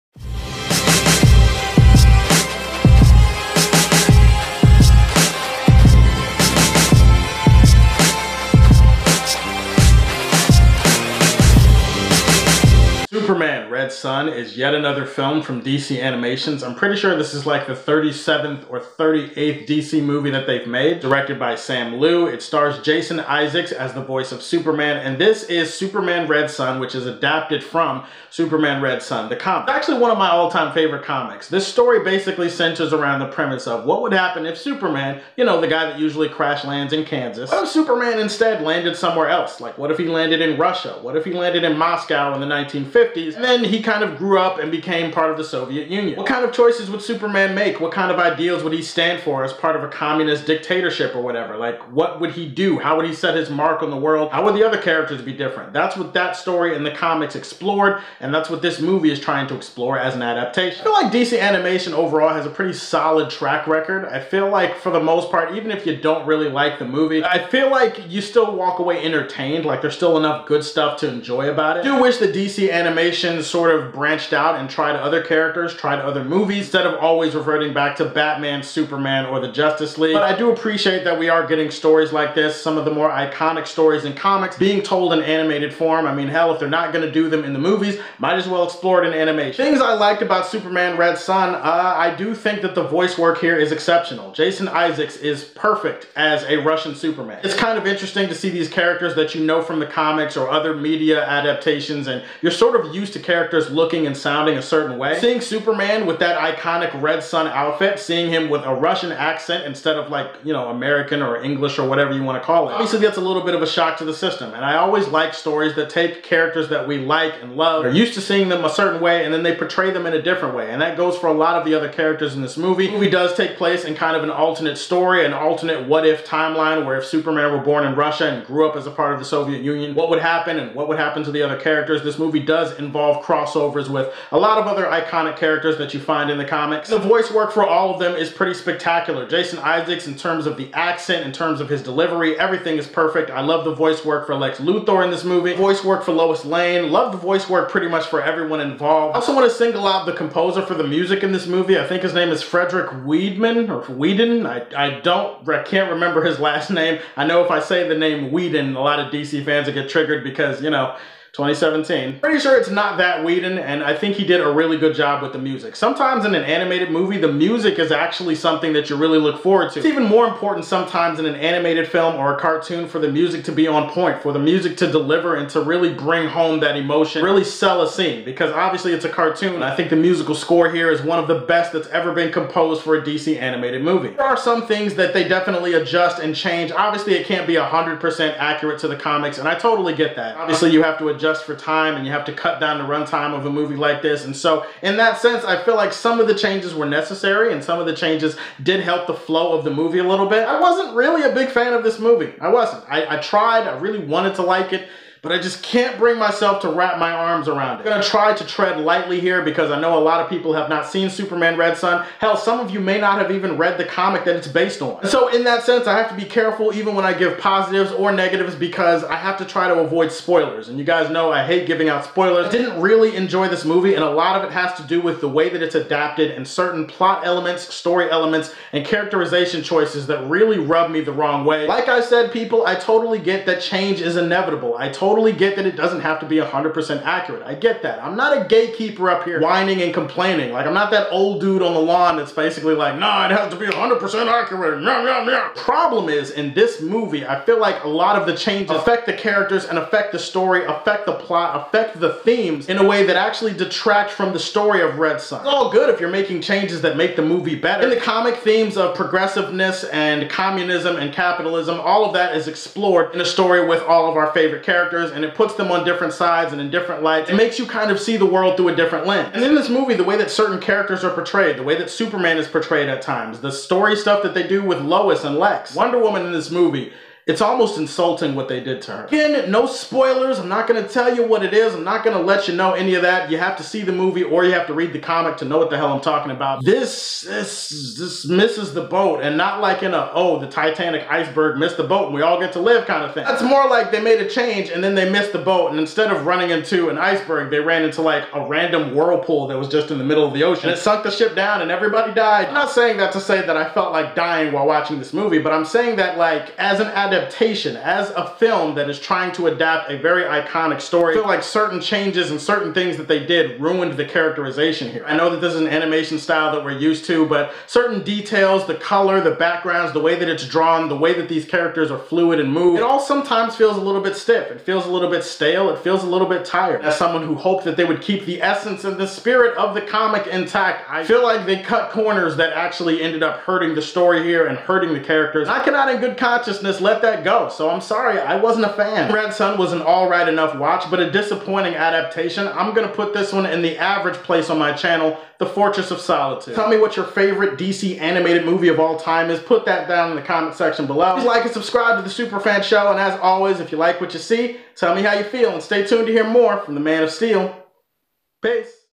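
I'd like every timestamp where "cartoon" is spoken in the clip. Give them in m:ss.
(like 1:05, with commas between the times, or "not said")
2:52, 2:59.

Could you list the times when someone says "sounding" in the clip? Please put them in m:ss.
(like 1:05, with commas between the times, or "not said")
1:44.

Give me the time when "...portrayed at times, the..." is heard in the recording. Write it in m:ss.
4:32.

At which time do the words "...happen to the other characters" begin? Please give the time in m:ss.
2:10.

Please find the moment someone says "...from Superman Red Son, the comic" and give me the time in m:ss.
0:27.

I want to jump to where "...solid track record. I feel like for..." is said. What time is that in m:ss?
1:02.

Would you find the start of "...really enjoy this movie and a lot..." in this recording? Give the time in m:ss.
3:42.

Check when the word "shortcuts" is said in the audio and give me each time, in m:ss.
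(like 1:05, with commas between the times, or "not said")
not said.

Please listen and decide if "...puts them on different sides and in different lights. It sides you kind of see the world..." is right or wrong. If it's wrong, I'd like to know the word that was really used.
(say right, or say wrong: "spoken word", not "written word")
wrong: "makes", not "sides".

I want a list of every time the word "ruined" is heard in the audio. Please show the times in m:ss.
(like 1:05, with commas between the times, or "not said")
5:13.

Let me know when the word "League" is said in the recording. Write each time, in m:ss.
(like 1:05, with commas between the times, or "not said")
1:19.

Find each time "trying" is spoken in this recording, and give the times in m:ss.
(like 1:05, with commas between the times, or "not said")
0:59, 5:08.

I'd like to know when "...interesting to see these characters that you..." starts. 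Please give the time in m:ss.
1:37.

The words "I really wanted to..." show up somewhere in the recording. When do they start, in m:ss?
3:23.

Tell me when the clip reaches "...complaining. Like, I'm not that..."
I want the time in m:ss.
3:59.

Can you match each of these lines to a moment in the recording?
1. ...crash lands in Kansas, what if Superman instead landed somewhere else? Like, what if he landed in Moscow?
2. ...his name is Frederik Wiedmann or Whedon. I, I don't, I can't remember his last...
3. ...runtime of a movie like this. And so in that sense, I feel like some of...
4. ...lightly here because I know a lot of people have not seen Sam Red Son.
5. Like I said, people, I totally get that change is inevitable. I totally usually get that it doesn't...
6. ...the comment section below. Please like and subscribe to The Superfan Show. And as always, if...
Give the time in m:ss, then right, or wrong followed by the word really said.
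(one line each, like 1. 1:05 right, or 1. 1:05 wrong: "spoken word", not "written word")
1. 0:36 wrong: "Russia", not "Moscow"
2. 2:32 right
3. 3:12 right
4. 3:28 wrong: "Superman", not "Sam"
5. 3:51 wrong: "totally", not "usually"
6. 5:50 right.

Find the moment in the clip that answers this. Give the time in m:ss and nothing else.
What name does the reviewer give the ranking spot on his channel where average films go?
5:45.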